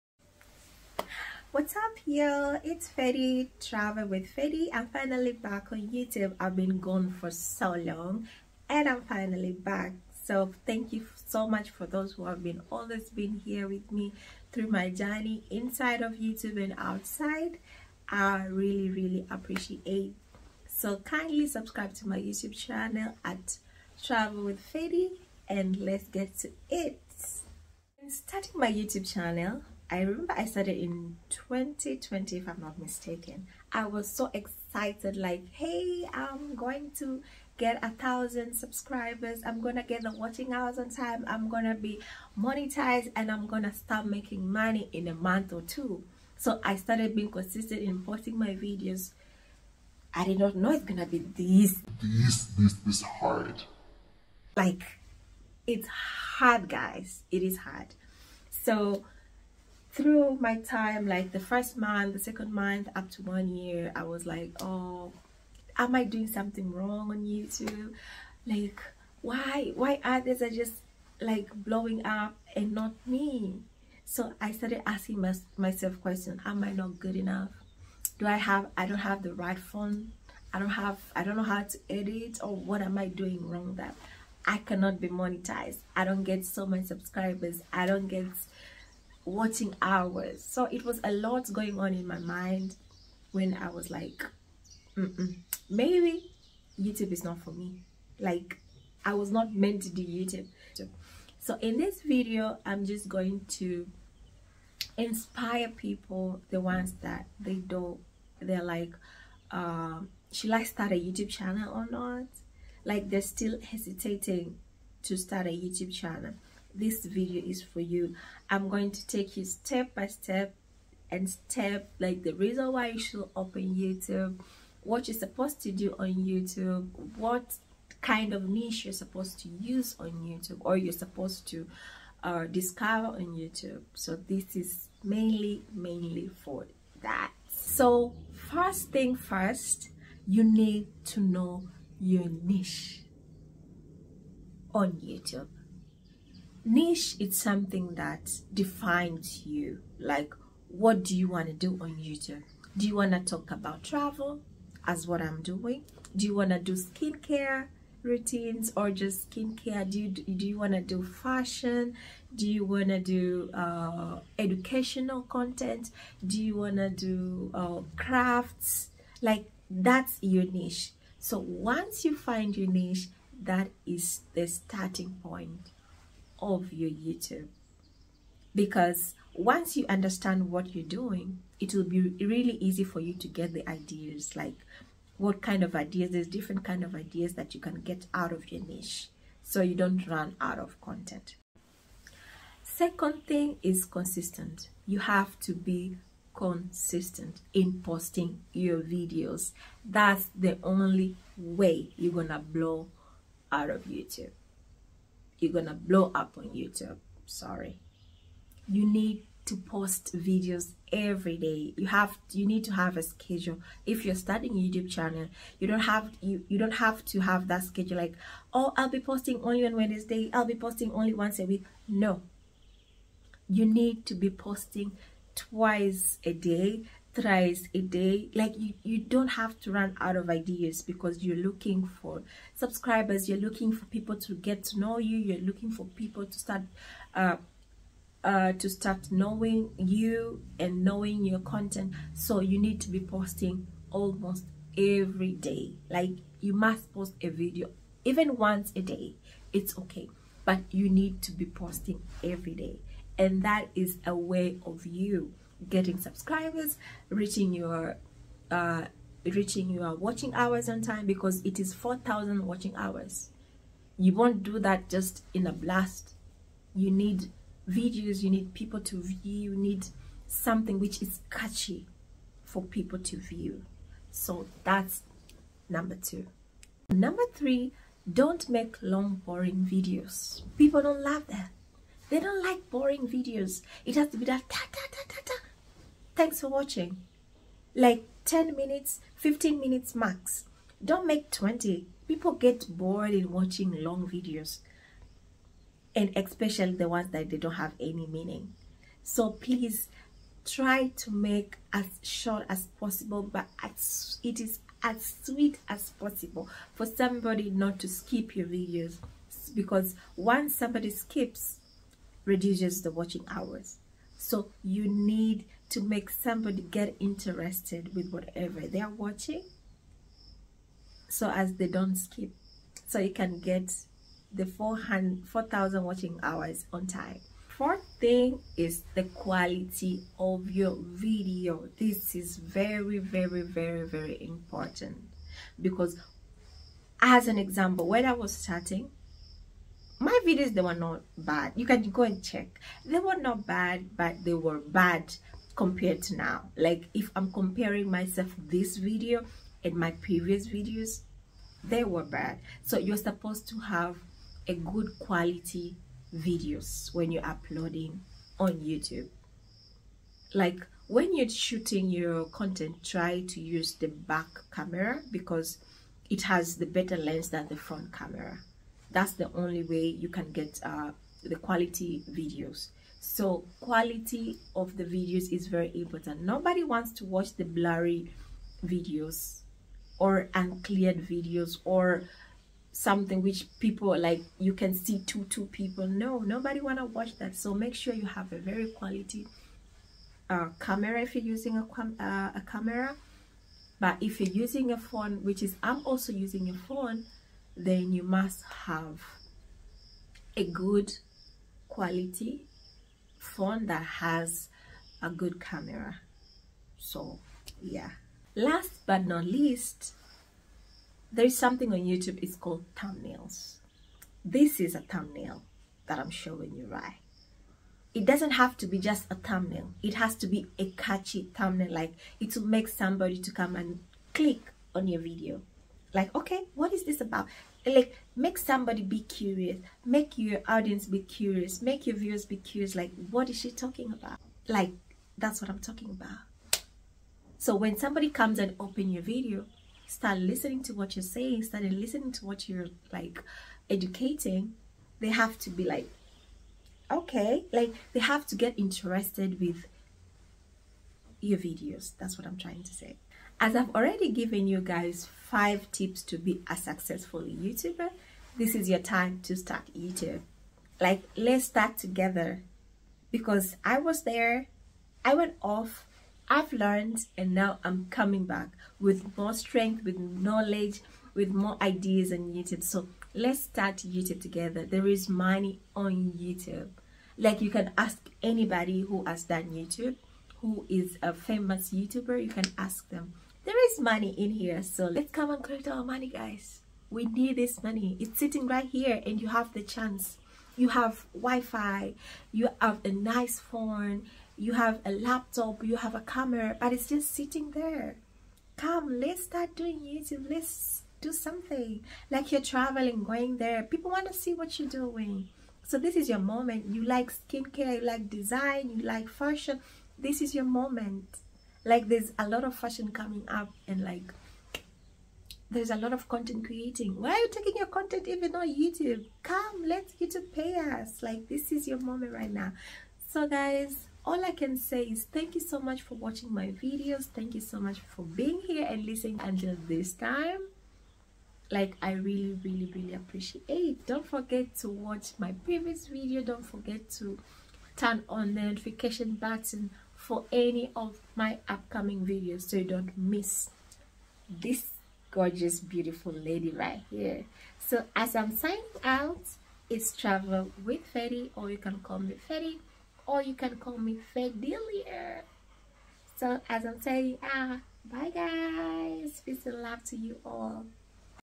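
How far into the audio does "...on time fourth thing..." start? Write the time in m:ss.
5:26.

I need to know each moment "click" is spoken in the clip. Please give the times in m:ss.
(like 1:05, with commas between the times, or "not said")
7:04.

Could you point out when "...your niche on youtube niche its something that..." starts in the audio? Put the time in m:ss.
2:21.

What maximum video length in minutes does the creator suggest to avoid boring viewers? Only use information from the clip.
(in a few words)
15 minutes.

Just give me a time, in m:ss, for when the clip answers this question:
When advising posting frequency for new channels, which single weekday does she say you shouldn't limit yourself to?
3:39.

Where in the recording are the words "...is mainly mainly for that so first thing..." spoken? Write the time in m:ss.
2:14.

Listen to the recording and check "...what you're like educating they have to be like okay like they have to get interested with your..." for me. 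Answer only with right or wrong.
right.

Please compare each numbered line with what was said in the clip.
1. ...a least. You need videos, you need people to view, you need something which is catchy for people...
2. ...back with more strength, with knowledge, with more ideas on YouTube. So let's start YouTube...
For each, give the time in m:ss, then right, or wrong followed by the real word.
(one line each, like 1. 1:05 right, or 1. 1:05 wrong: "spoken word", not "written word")
1. 4:25 wrong: "blast", not "least"
2. 7:48 right.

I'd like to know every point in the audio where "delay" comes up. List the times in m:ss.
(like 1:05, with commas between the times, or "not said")
not said.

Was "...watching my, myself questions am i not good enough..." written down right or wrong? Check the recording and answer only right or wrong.
wrong.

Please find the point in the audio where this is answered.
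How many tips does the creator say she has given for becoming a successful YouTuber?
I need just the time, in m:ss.
7:35.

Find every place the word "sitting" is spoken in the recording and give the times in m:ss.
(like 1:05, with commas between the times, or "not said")
8:08, 8:17.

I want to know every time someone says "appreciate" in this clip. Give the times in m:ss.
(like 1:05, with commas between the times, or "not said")
0:19, 8:52.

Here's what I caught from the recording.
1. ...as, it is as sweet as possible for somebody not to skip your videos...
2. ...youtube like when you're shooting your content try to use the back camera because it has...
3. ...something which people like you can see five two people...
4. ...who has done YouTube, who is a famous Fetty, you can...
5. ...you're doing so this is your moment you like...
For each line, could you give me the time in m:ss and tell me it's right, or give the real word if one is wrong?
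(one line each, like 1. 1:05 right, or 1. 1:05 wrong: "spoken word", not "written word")
1. 5:03 right
2. 5:58 right
3. 6:22 wrong: "two", not "five"
4. 7:58 wrong: "YouTuber", not "Fetty"
5. 8:24 right.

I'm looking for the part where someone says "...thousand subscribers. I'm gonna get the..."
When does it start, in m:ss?
0:37.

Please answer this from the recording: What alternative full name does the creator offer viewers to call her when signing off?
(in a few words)
Fedilia.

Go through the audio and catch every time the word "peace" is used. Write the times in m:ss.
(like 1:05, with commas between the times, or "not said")
9:19.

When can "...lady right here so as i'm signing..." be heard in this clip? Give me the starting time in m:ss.
9:06.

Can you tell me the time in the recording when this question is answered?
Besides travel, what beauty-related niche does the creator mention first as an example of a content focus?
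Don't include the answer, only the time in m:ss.
2:36.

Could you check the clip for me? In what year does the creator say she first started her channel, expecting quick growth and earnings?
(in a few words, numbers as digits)
2020.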